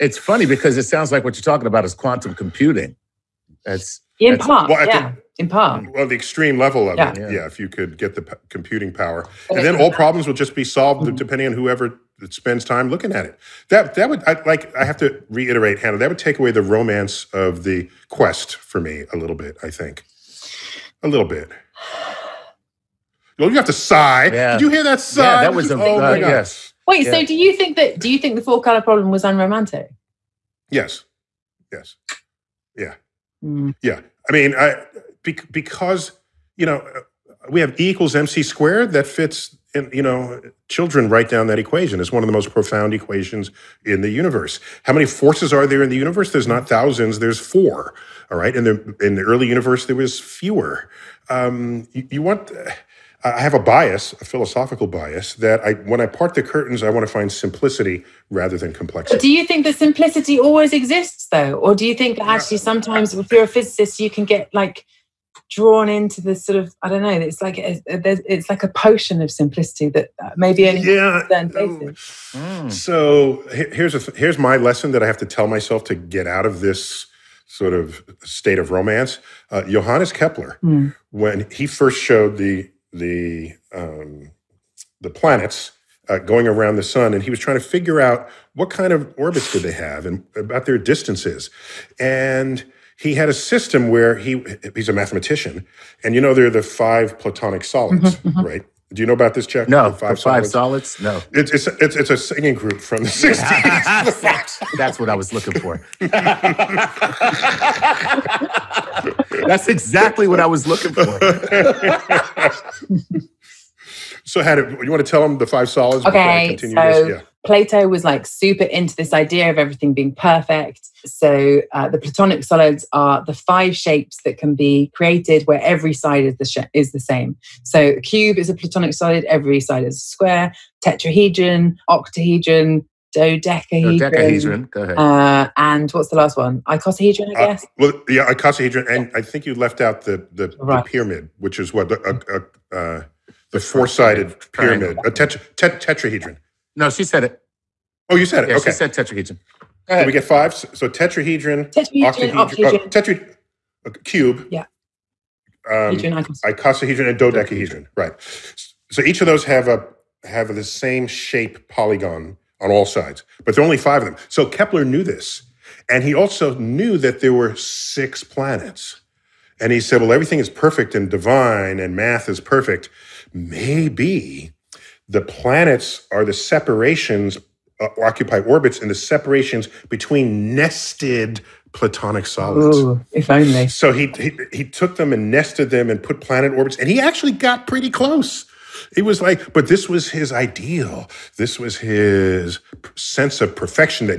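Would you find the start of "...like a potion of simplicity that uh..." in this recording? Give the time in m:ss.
1:08.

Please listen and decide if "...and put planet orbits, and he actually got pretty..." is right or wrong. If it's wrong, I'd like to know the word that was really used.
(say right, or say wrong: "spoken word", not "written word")
right.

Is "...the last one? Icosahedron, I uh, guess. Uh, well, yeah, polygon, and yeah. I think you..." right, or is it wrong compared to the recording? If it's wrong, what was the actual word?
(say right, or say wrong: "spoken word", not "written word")
wrong: "icosahedron", not "polygon".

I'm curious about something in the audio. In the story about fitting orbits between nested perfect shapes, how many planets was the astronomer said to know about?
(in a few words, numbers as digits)
6.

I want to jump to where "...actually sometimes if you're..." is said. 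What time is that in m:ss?
1:02.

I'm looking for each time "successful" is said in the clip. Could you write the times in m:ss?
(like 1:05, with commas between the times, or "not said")
not said.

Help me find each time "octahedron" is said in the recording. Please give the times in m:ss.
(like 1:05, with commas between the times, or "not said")
2:11, 2:32.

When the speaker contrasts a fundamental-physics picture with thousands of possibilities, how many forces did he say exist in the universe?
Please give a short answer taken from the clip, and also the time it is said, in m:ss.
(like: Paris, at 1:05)
4, at 0:47.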